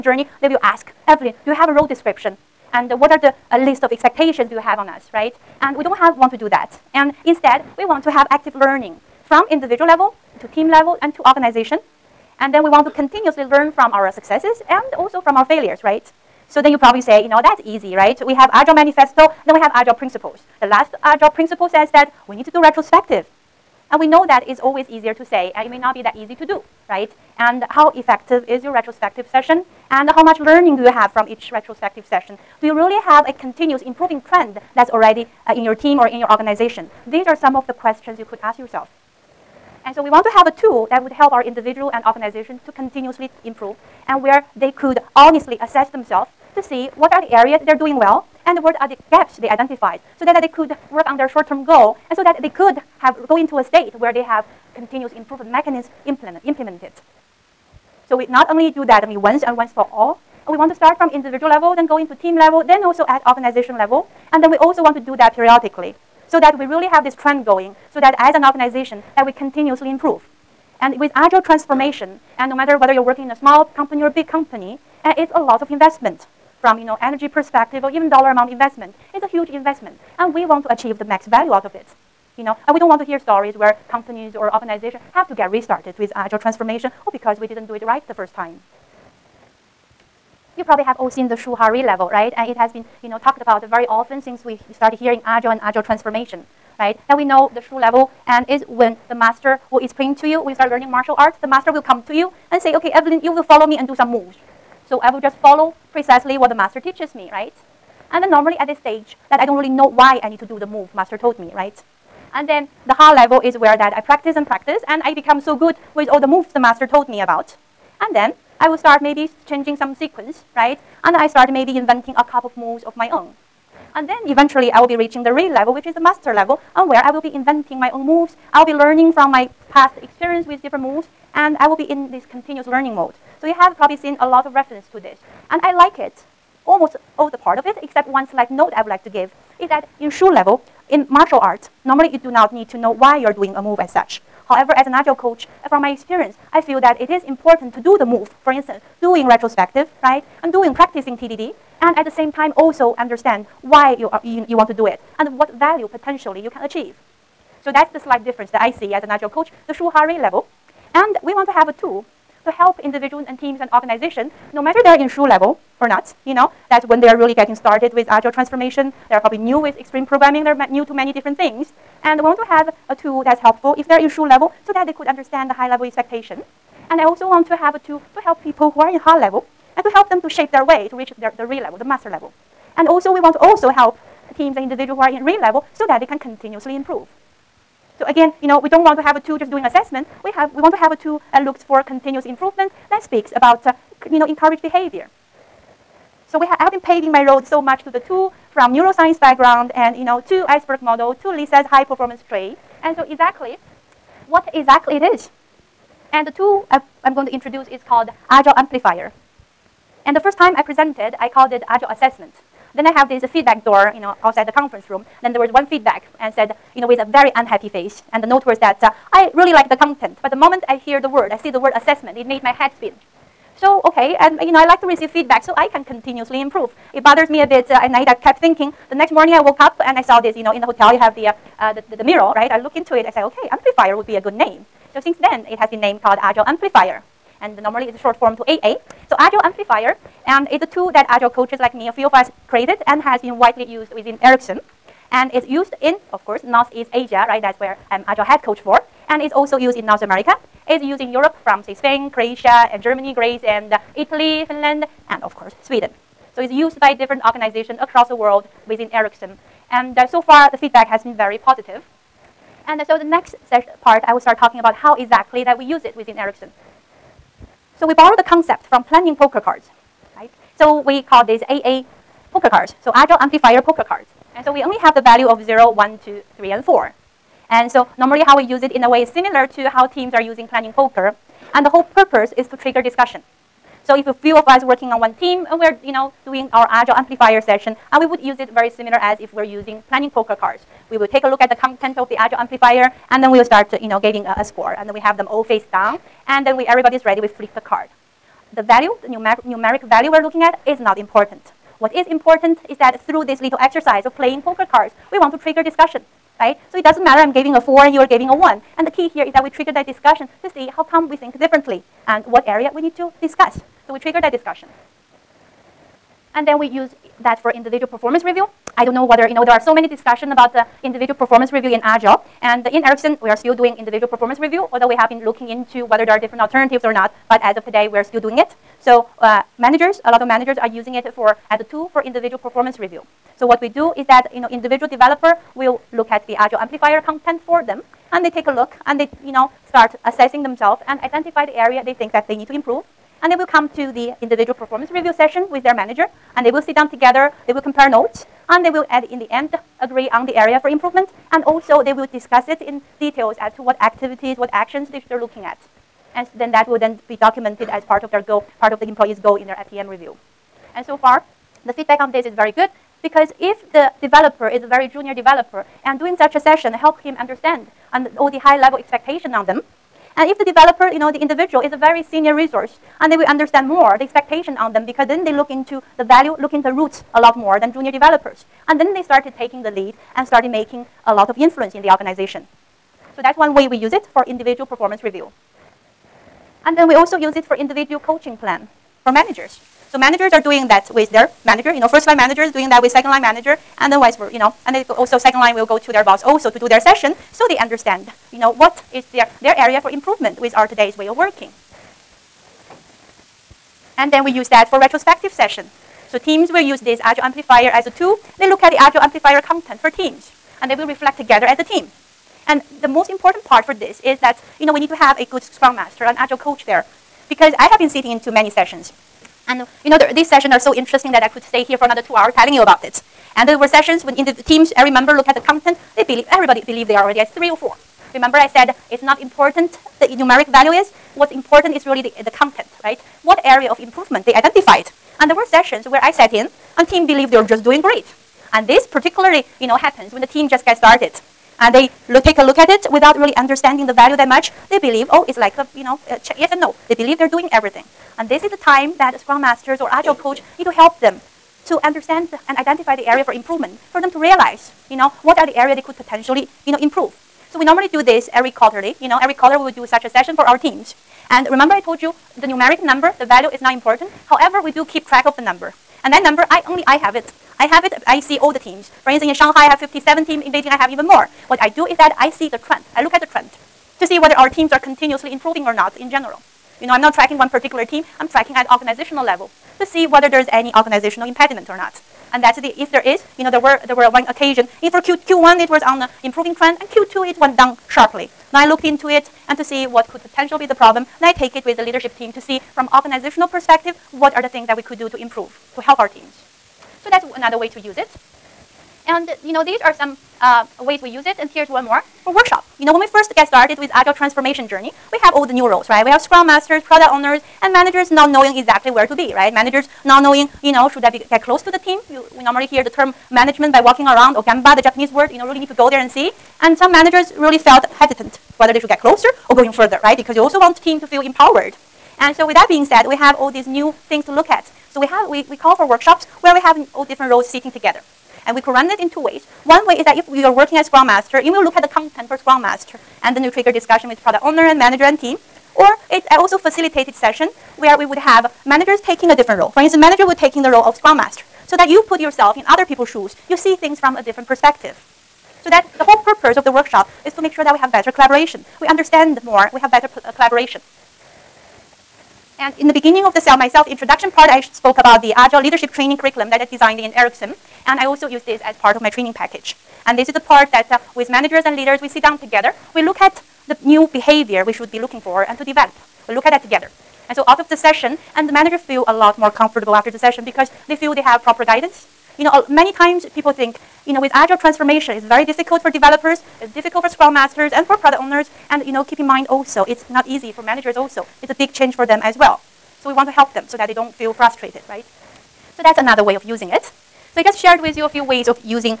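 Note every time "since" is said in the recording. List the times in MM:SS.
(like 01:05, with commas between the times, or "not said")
01:34, 03:54.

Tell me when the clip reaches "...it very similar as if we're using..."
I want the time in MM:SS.
04:48.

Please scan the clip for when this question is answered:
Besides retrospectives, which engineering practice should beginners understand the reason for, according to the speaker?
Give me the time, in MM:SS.
02:31.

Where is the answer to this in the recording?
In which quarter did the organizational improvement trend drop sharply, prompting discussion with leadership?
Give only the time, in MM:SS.
08:06.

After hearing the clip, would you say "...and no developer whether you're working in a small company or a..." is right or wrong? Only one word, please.
wrong.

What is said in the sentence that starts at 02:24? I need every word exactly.
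However, as an agile coach, uh, from my experience, I feel that it is important to do the move.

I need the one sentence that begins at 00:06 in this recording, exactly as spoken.
And instead, we want to have active learning from individual level to team level and to organization.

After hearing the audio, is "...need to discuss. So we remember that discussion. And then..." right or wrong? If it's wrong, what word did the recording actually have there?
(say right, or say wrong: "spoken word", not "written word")
wrong: "trigger", not "remember".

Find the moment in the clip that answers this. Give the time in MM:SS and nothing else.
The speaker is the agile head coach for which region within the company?
04:06.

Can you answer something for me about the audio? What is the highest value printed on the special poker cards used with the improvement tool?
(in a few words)
4.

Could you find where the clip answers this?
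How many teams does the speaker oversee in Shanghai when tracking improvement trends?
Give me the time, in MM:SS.
07:49.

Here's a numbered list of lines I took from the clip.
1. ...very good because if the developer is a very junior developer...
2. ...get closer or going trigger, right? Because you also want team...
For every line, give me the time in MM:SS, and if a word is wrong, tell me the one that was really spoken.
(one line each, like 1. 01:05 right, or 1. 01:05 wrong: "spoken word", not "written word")
1. 06:02 right
2. 08:38 wrong: "further", not "trigger".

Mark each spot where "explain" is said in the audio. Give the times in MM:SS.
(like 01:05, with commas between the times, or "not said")
01:39.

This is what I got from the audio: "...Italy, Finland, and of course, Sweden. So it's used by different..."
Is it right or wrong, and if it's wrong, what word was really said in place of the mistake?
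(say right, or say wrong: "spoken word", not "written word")
right.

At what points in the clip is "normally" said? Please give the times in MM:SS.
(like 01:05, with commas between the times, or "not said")
01:48, 02:21, 03:57, 04:37, 07:37, 08:32.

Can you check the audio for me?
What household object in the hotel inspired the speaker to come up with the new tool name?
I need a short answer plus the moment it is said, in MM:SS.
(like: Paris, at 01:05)
mirror, at 03:52.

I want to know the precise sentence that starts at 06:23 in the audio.
So that's one way we use it for individual performance review.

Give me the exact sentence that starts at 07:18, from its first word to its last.
And this particularly, you know, happens when the team just gets started.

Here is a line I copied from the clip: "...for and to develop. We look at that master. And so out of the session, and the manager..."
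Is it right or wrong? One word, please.
wrong.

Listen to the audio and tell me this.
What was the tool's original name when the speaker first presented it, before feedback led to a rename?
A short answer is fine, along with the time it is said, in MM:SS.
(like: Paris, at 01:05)
Agile Assessment, at 03:31.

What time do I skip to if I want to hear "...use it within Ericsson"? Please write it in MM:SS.
04:25.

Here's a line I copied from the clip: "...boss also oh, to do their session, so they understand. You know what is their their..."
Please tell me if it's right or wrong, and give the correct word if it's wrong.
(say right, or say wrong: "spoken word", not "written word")
right.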